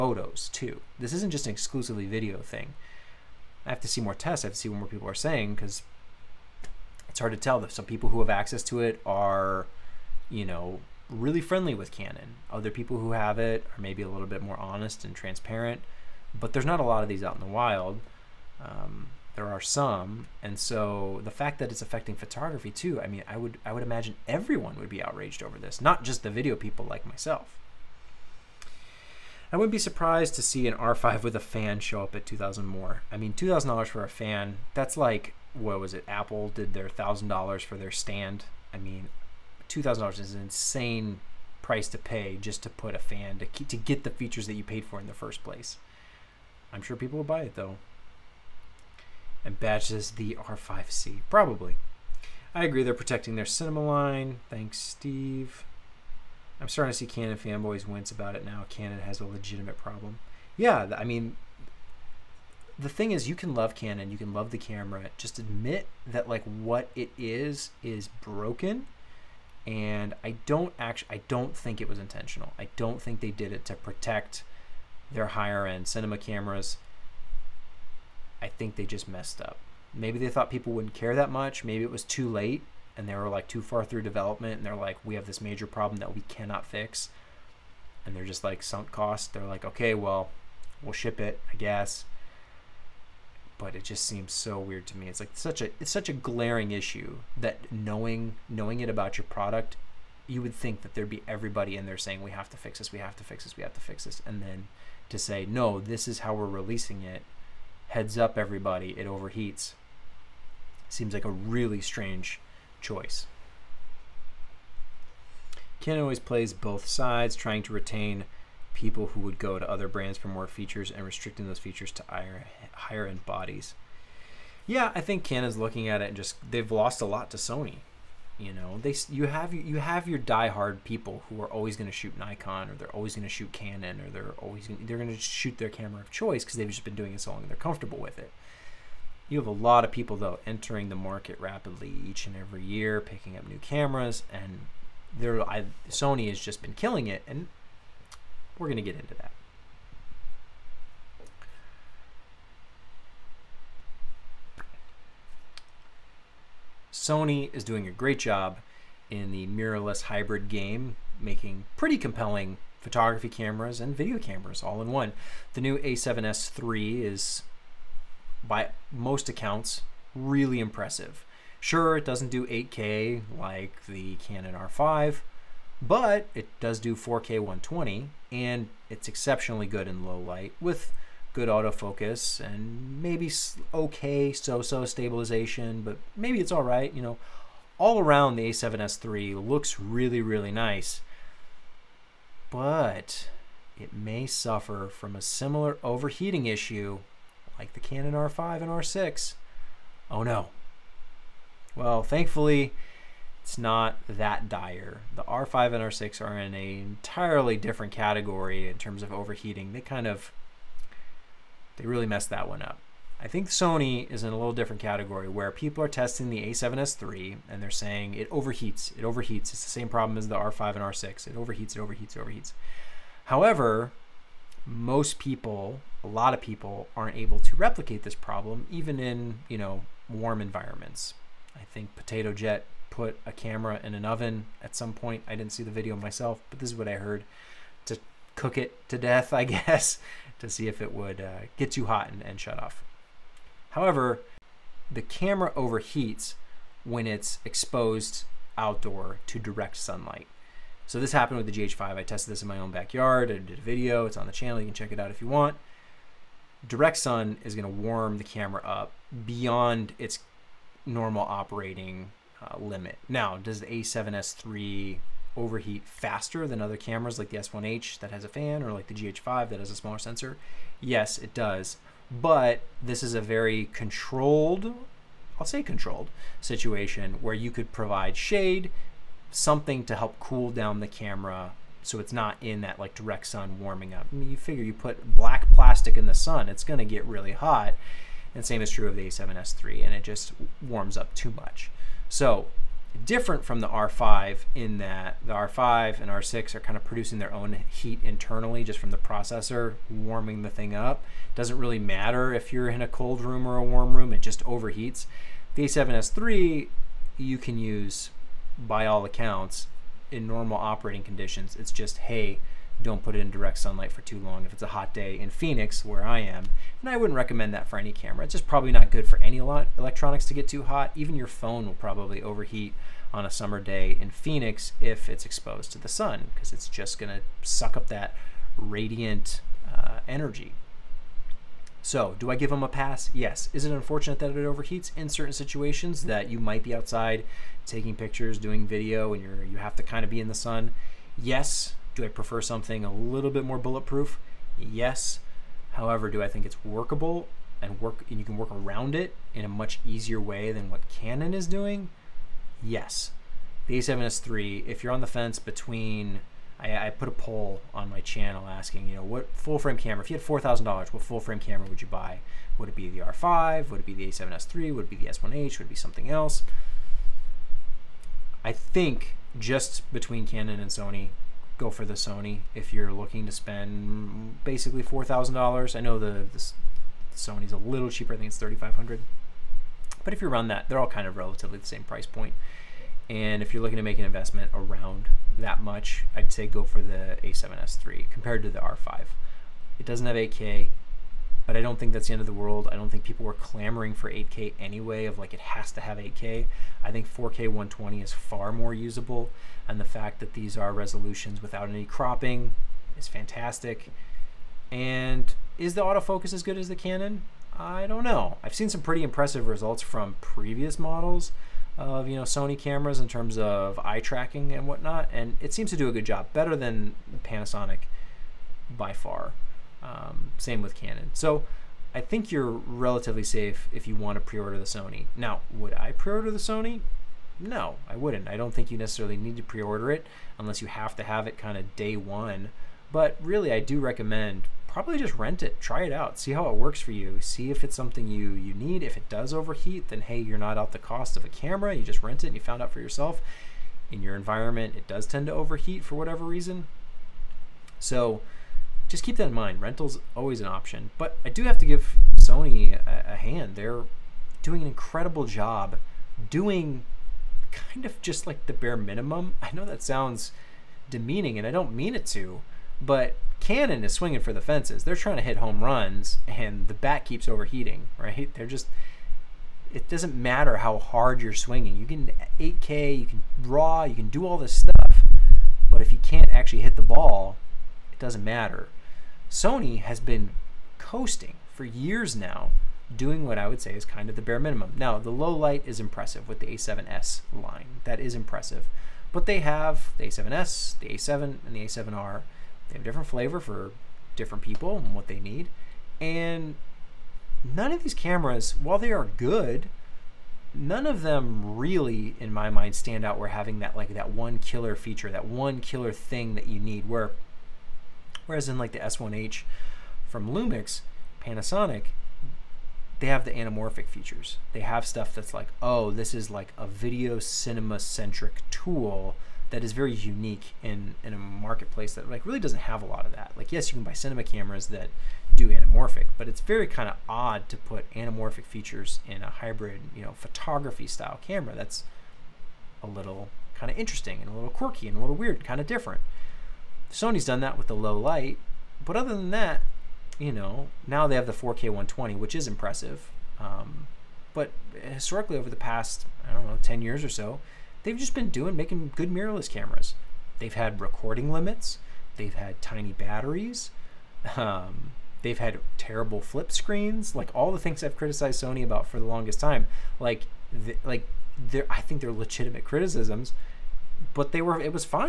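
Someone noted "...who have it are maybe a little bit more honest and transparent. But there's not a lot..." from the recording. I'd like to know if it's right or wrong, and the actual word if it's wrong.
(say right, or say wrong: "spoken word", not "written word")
right.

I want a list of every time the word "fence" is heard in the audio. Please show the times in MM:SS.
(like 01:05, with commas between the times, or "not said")
05:55, 07:44.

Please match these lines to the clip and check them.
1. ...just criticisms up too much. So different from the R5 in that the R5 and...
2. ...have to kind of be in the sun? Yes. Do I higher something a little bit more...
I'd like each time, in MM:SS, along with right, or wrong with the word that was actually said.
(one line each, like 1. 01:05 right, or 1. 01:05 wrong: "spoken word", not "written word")
1. 04:50 wrong: "warms", not "criticisms"
2. 05:39 wrong: "prefer", not "higher".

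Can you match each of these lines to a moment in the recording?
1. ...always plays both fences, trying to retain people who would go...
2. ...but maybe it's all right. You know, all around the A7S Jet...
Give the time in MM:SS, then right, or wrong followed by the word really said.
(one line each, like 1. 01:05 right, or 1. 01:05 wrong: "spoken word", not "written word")
1. 01:56 wrong: "sides", not "fences"
2. 03:05 wrong: "III", not "Jet".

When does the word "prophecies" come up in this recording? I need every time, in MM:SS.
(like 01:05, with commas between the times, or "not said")
not said.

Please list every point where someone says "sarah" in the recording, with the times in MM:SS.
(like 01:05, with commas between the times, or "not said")
not said.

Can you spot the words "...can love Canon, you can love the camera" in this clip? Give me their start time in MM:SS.
01:03.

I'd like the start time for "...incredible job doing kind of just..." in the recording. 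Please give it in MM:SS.
07:34.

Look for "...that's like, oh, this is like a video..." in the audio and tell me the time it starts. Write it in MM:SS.
08:35.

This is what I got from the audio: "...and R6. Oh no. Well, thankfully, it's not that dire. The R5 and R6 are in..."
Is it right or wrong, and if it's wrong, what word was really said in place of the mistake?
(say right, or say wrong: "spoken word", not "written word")
right.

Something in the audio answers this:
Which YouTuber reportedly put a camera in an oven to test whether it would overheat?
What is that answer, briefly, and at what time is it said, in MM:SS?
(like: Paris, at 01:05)
Potato Jet, at 03:51.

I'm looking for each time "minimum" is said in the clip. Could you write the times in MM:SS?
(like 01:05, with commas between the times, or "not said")
07:38, 08:04.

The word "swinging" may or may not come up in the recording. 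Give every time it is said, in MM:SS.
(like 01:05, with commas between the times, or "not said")
07:43, 07:51.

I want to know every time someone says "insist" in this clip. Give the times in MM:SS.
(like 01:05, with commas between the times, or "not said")
not said.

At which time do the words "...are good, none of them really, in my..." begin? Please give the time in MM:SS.
08:18.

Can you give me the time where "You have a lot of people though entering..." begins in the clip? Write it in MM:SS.
02:19.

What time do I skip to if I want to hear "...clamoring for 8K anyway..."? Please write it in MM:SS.
06:33.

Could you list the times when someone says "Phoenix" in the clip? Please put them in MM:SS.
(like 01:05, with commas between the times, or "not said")
05:15, 05:24.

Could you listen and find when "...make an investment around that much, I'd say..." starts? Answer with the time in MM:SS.
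06:23.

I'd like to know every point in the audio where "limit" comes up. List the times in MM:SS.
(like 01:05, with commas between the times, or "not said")
04:22, 09:11.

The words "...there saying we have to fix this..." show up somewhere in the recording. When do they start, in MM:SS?
01:41.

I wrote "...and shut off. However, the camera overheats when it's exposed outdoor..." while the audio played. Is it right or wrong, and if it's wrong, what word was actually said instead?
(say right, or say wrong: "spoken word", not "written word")
right.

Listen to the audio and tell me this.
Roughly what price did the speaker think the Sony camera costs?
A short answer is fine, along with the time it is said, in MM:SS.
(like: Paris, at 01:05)
3500, at 06:18.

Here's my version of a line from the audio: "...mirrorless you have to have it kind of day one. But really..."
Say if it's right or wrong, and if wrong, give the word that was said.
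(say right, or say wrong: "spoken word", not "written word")
wrong: "unless", not "mirrorless".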